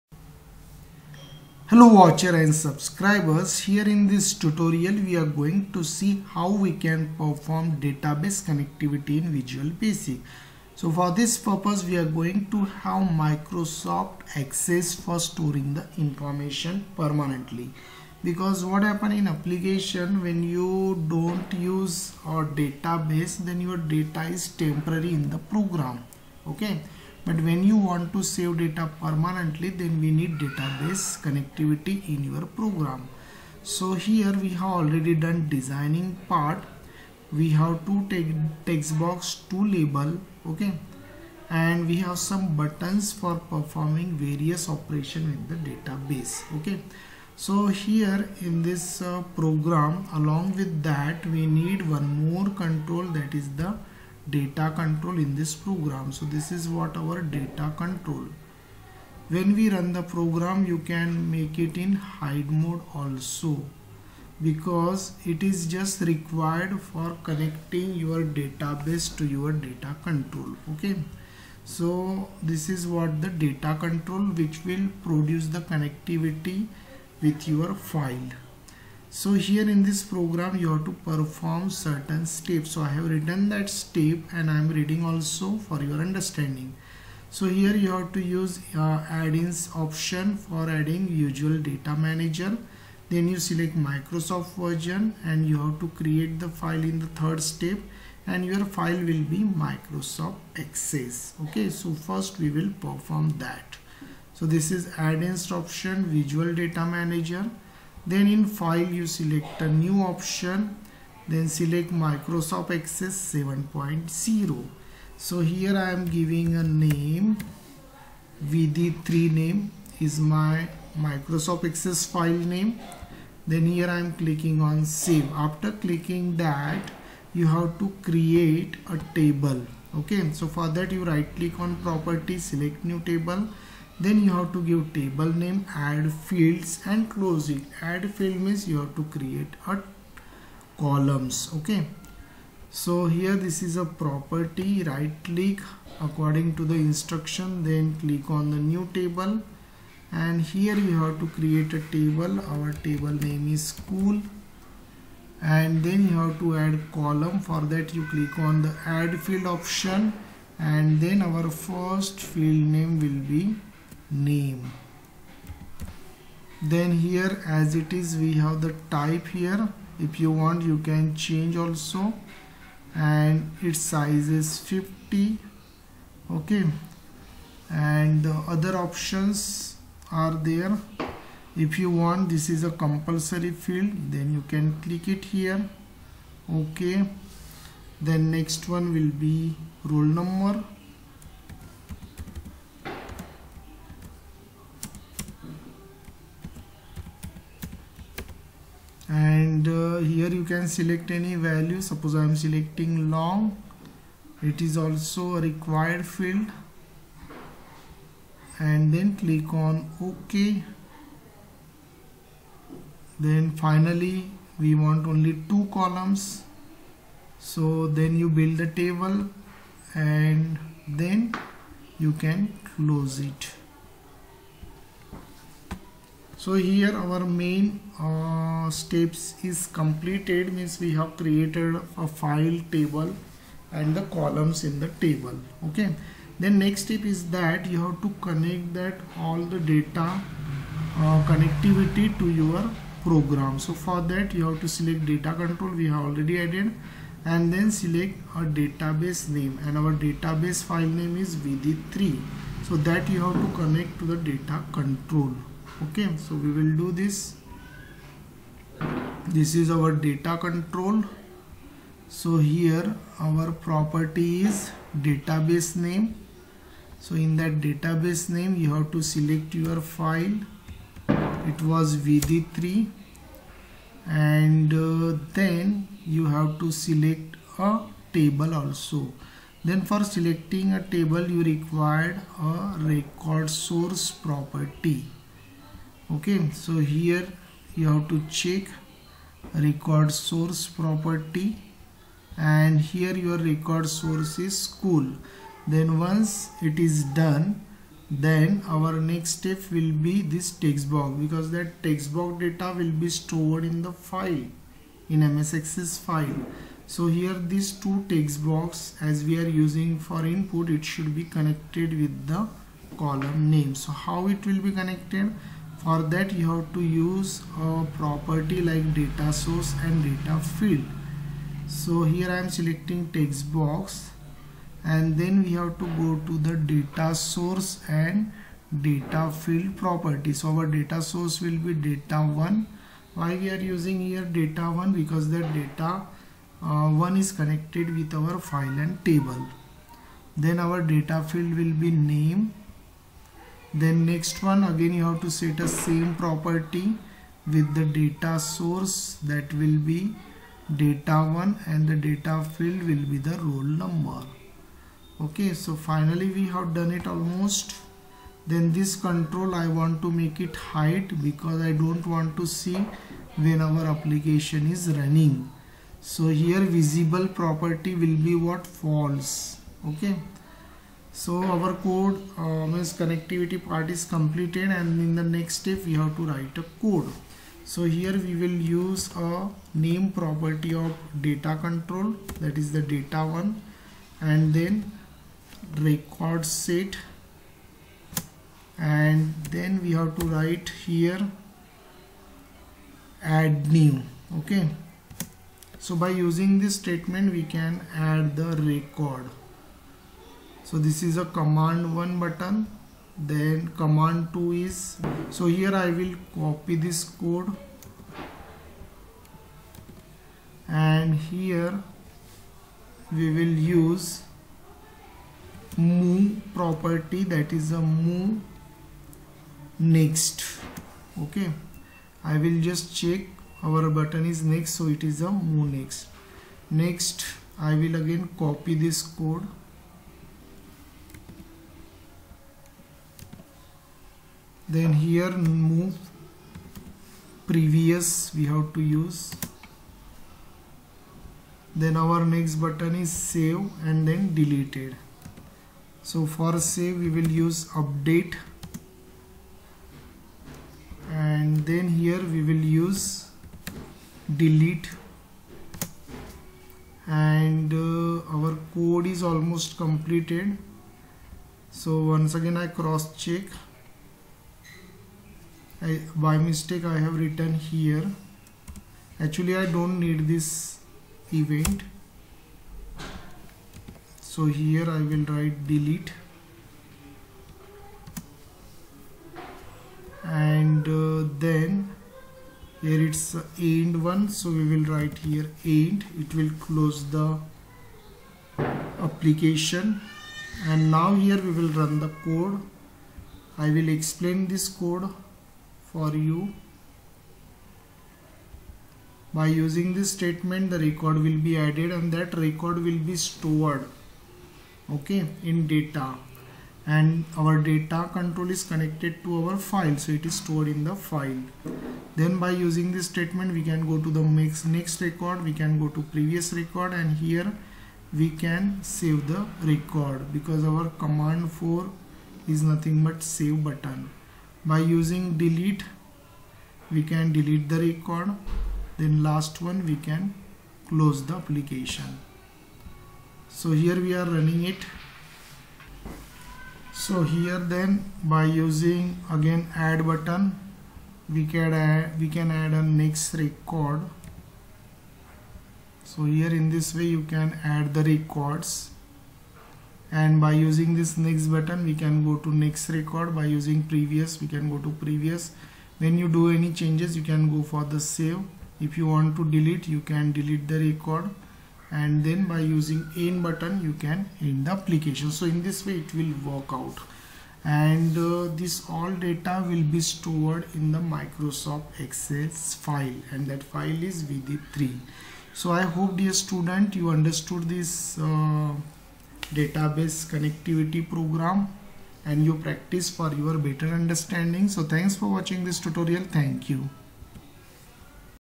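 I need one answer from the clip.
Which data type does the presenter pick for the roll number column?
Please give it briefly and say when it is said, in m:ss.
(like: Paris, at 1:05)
long, at 3:23.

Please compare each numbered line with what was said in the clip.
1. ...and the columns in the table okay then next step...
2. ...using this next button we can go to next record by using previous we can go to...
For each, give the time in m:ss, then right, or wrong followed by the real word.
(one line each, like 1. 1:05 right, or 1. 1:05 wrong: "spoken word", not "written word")
1. 3:53 right
2. 9:10 right.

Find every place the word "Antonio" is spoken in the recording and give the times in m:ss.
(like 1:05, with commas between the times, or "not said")
not said.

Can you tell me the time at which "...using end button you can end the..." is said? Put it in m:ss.
9:22.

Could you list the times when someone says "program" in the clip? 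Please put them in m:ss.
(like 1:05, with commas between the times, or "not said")
0:25, 0:32, 0:49, 0:55, 1:00, 1:20, 4:03, 9:41.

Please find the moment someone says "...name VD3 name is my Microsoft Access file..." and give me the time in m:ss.
1:56.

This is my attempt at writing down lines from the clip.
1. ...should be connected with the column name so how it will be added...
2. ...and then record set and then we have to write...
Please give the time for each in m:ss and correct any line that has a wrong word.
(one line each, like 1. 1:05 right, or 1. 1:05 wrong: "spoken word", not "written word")
1. 5:10 wrong: "connected", not "added"
2. 6:24 right.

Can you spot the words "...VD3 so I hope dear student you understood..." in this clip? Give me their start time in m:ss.
9:34.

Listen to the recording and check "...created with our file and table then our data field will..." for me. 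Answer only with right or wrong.
wrong.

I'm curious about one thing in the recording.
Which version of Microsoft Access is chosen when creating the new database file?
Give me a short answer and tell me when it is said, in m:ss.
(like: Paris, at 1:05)
7.0, at 1:51.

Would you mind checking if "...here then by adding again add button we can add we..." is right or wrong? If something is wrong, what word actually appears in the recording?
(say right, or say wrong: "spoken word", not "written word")
wrong: "using", not "adding".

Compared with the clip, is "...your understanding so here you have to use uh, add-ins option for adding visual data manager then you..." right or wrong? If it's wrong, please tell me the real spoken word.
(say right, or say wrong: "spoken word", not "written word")
right.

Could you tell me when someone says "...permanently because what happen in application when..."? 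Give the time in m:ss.
0:16.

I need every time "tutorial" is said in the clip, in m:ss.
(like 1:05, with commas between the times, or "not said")
0:04, 9:45.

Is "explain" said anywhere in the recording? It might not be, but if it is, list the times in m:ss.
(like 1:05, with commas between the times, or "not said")
8:13.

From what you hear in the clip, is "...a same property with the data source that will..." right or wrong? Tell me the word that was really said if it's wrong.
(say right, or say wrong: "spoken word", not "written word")
right.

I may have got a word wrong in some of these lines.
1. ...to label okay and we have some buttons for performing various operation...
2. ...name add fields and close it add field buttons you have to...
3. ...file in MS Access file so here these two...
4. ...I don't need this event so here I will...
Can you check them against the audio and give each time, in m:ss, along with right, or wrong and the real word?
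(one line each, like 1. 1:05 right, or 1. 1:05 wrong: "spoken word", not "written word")
1. 0:39 right
2. 2:15 wrong: "means", not "buttons"
3. 5:03 right
4. 7:49 right.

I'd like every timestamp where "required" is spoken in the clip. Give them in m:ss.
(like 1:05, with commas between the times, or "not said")
1:06, 3:25, 4:41.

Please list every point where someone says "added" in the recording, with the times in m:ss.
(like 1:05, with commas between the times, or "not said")
4:06, 8:21.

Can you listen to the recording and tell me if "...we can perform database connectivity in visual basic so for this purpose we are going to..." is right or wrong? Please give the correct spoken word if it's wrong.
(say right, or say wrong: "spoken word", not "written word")
right.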